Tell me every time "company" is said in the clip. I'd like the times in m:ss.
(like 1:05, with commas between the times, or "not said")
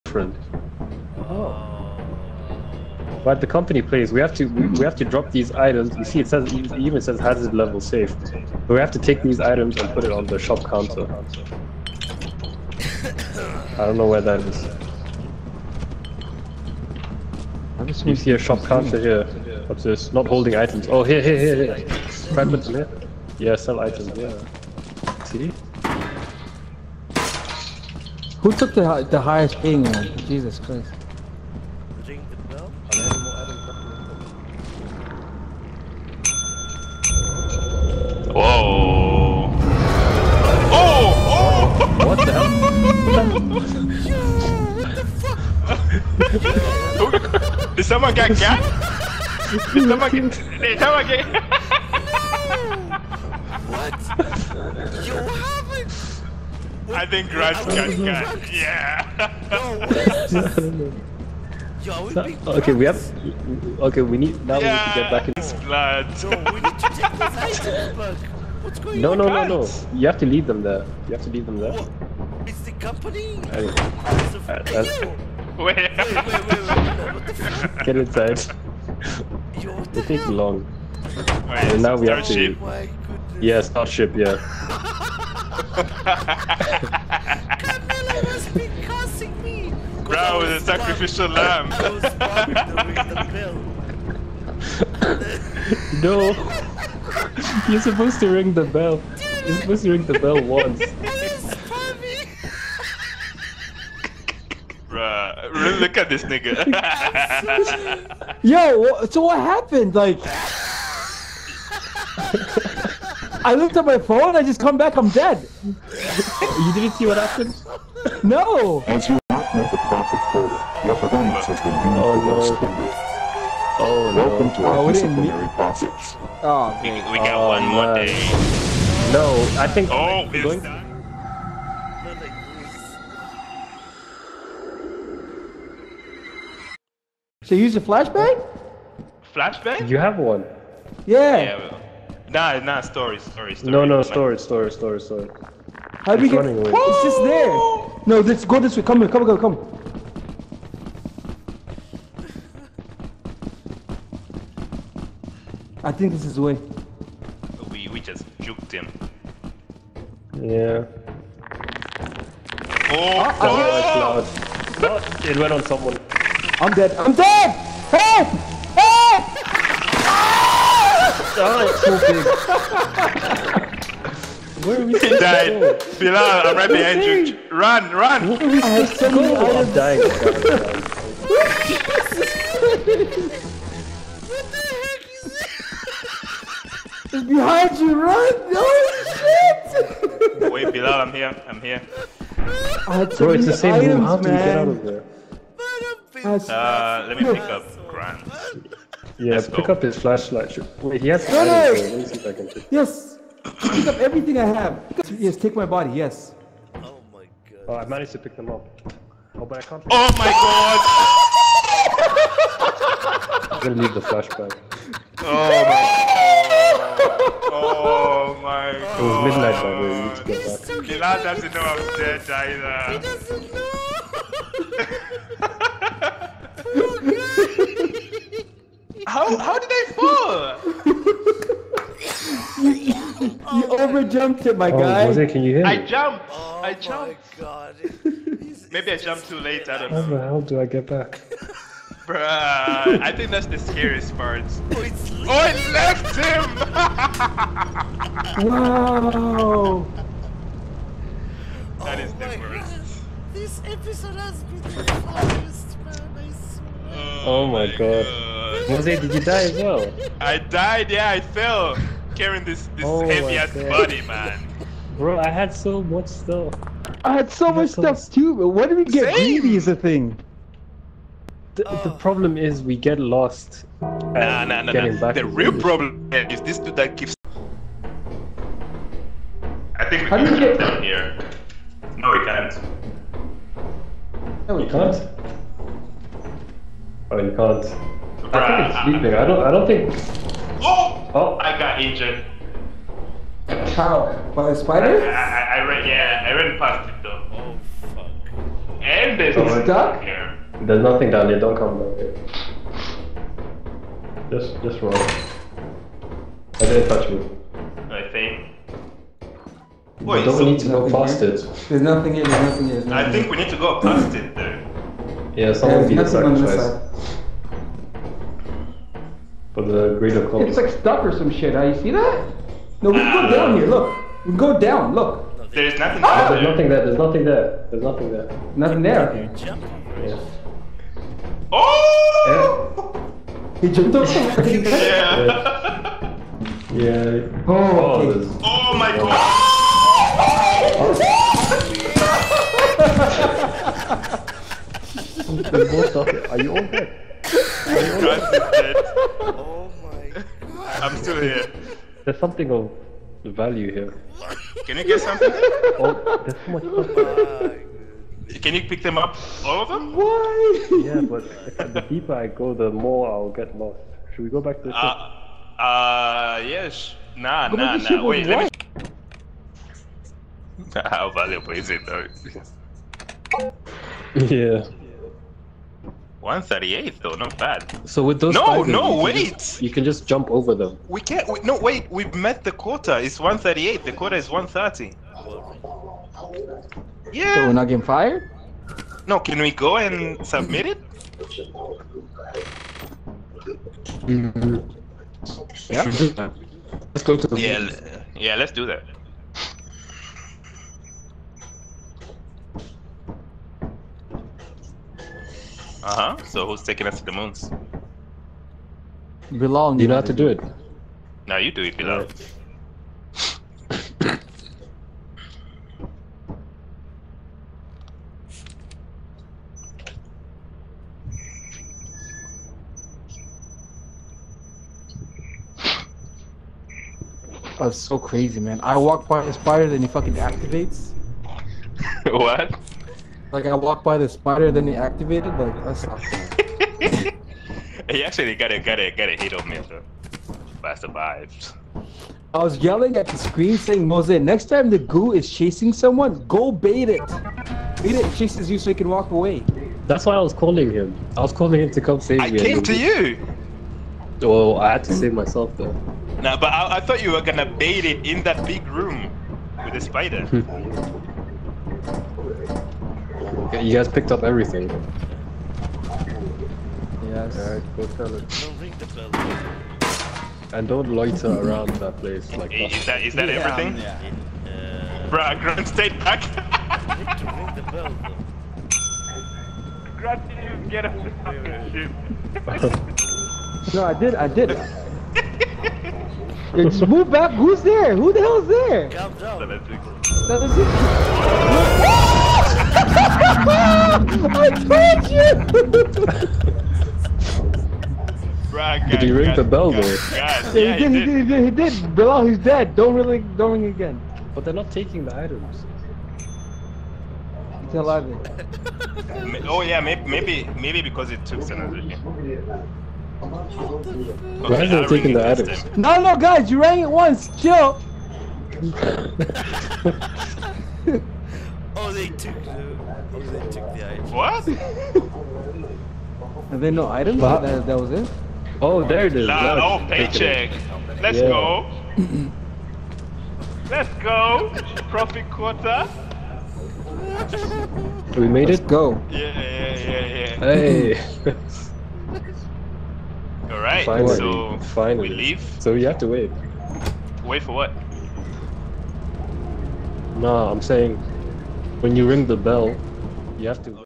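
0:03, 1:12.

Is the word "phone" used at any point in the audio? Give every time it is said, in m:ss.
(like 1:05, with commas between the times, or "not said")
1:53.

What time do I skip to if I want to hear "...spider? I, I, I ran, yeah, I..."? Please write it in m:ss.
4:54.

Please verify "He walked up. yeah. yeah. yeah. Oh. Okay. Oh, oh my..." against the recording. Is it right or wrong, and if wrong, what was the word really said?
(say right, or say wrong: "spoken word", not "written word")
wrong: "jumped", not "walked".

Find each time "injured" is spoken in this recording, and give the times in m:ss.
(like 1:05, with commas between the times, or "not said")
4:51.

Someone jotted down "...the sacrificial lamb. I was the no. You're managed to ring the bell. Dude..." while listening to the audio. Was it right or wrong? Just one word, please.
wrong.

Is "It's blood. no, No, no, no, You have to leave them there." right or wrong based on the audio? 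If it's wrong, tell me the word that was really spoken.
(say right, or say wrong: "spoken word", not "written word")
right.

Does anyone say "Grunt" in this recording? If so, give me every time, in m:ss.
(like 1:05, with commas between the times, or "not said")
7:55, 7:59.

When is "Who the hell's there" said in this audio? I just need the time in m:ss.
8:07.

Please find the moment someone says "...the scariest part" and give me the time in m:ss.
4:03.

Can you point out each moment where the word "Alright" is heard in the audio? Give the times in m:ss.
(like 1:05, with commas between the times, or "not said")
7:47, 9:03.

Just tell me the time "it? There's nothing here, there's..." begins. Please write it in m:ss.
5:11.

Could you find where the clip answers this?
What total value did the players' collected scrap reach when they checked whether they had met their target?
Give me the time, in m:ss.
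6:16.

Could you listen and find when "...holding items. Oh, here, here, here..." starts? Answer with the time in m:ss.
0:20.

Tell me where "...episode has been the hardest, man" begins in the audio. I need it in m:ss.
4:13.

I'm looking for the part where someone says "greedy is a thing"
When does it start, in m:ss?
4:29.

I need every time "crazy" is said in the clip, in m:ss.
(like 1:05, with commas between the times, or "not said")
7:07.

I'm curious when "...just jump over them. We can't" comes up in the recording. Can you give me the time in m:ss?
6:19.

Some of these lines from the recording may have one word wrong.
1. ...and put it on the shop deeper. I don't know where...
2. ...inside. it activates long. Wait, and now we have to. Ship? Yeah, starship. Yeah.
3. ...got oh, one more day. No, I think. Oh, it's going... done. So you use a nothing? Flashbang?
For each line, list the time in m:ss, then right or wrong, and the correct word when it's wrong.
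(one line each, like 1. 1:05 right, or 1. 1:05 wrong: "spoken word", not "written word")
1. 0:09 wrong: "counter", not "deeper"
2. 1:17 wrong: "takes", not "activates"
3. 2:07 wrong: "flashbang", not "nothing".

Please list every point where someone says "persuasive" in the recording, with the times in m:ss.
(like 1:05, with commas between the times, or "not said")
not said.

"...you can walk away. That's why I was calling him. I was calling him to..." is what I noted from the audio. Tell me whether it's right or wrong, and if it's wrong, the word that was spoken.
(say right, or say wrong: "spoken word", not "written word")
right.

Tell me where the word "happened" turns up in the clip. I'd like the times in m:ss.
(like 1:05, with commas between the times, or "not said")
1:49, 1:57.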